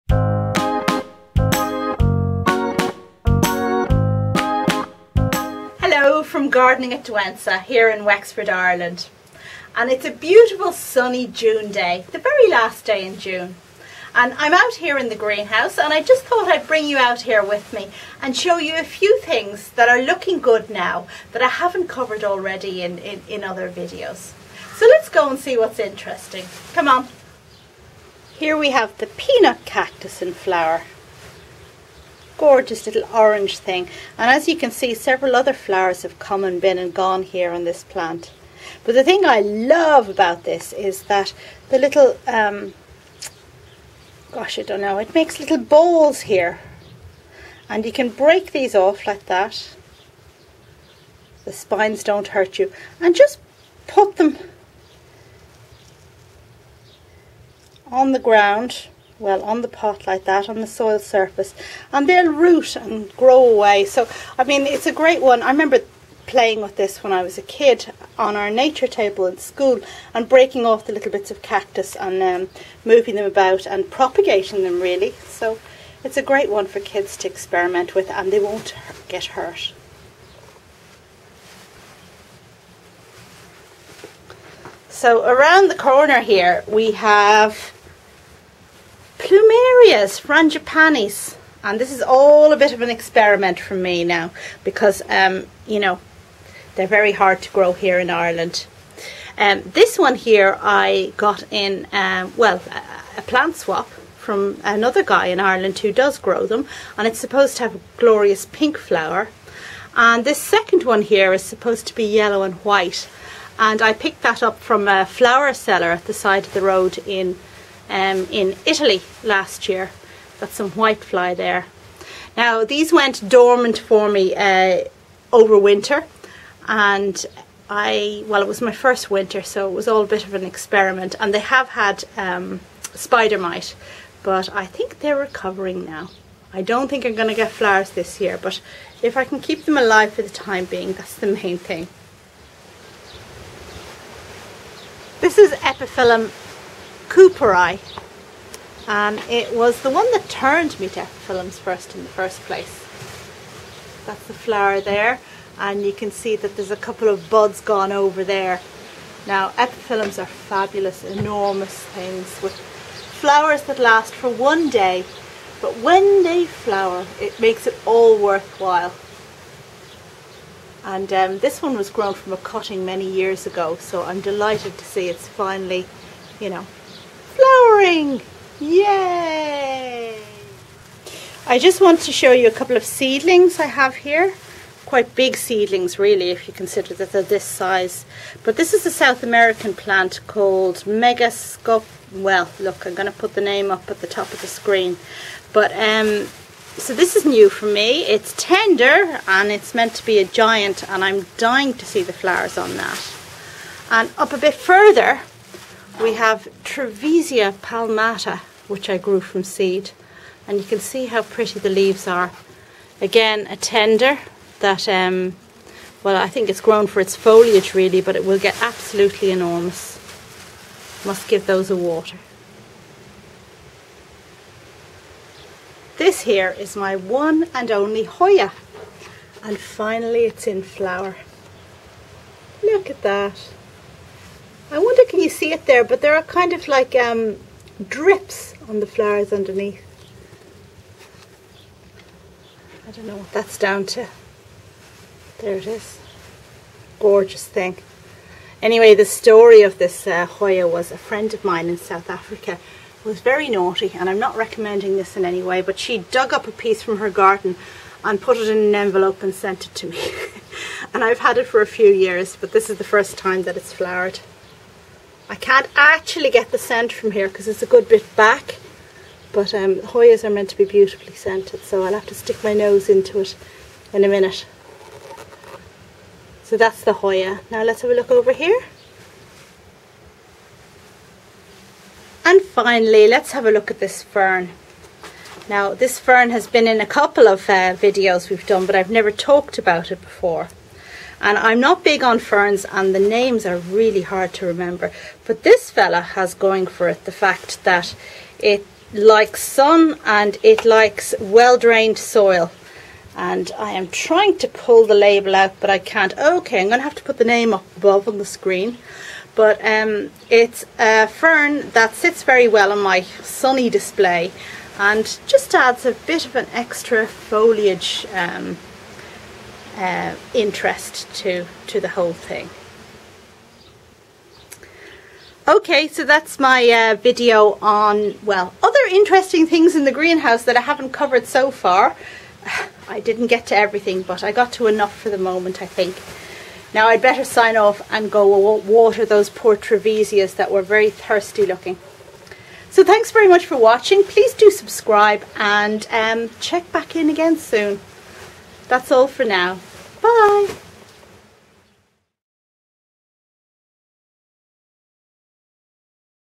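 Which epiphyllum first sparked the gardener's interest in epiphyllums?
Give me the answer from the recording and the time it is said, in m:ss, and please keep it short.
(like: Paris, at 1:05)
Epiphyllum Cooperii, at 2:25.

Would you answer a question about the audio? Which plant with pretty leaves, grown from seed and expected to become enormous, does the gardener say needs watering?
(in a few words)
Trevesia palmata.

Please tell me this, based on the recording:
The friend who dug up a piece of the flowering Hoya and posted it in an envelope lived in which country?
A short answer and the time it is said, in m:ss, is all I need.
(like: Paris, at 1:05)
South Africa, at 4:11.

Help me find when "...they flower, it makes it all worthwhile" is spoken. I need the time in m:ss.
2:46.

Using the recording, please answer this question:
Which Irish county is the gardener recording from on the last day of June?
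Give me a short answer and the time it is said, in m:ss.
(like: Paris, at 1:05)
Wexford, at 0:08.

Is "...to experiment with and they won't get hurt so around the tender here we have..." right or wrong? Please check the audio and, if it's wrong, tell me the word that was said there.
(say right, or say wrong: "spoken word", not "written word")
wrong: "corner", not "tender".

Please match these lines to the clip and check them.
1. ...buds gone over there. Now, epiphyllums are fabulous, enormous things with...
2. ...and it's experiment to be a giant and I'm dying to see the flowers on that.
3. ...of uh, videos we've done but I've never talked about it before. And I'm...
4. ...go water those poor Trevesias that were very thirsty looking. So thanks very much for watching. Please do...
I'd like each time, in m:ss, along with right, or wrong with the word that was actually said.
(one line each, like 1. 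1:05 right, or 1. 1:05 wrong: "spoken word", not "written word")
1. 2:37 right
2. 3:19 wrong: "meant", not "experiment"
3. 4:47 right
4. 5:38 right.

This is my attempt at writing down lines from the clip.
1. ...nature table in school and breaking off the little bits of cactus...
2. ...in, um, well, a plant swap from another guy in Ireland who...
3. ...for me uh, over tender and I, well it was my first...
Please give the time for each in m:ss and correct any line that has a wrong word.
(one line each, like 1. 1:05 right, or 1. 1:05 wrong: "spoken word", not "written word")
1. 1:08 right
2. 1:41 right
3. 2:03 wrong: "winter", not "tender".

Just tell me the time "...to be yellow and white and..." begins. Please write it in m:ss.
1:51.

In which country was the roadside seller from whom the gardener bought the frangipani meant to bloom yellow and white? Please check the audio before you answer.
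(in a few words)
Italy.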